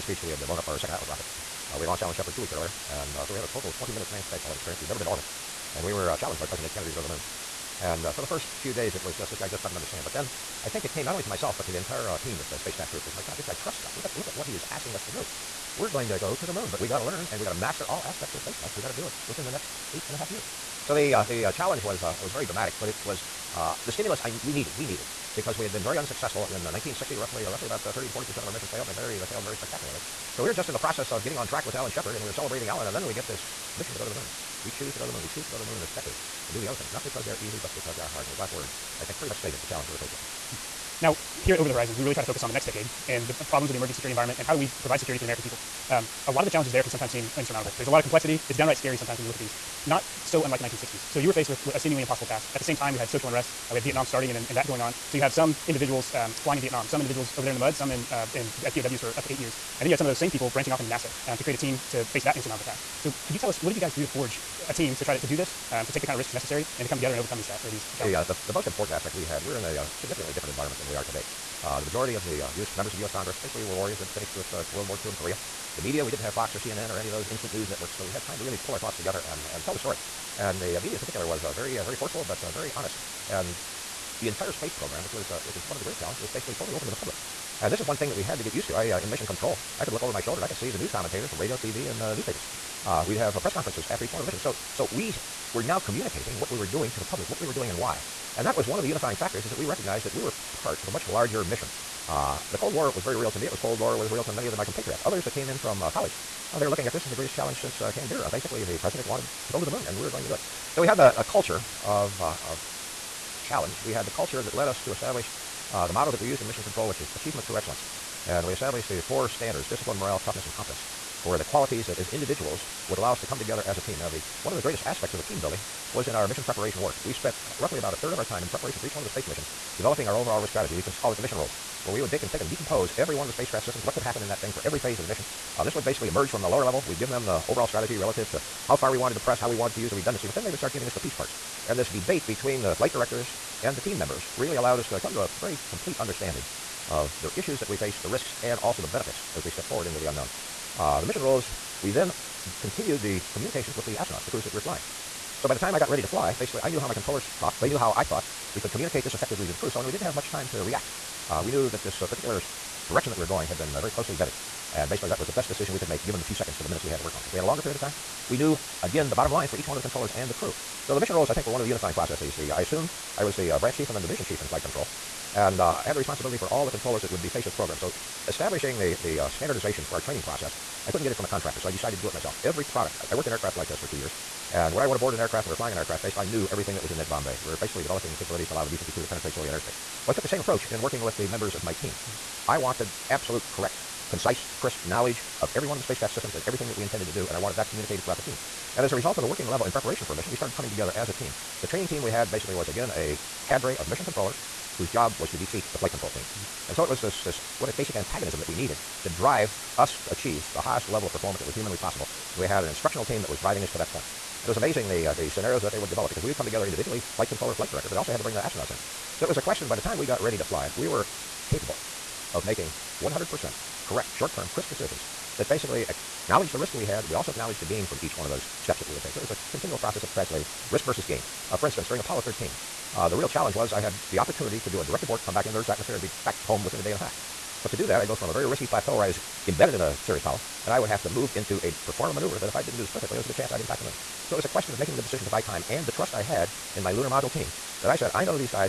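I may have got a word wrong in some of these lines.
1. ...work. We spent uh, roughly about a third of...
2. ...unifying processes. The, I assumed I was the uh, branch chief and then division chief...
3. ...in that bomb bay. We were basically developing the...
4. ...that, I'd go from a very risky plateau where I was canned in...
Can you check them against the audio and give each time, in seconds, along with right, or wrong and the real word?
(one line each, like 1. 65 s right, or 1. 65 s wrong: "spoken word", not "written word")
1. 126 s right
2. 171 s right
3. 186 s right
4. 237 s wrong: "embedded", not "canned".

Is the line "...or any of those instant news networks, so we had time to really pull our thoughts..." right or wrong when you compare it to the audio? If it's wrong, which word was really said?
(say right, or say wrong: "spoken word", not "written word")
right.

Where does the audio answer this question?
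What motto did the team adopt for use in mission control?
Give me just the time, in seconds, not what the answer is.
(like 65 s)
117 s.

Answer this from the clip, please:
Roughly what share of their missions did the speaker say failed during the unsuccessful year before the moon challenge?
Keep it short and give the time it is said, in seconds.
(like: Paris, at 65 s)
30 to 40 percent, at 27 s.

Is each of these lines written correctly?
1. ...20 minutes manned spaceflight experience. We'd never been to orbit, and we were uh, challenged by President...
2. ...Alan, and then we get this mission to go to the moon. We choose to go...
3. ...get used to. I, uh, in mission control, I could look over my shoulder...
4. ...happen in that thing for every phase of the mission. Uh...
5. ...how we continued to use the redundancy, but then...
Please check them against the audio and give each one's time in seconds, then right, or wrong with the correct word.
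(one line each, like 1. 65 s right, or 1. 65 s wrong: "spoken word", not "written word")
1. 3 s right
2. 32 s right
3. 88 s right
4. 134 s right
5. 139 s wrong: "wanted", not "continued".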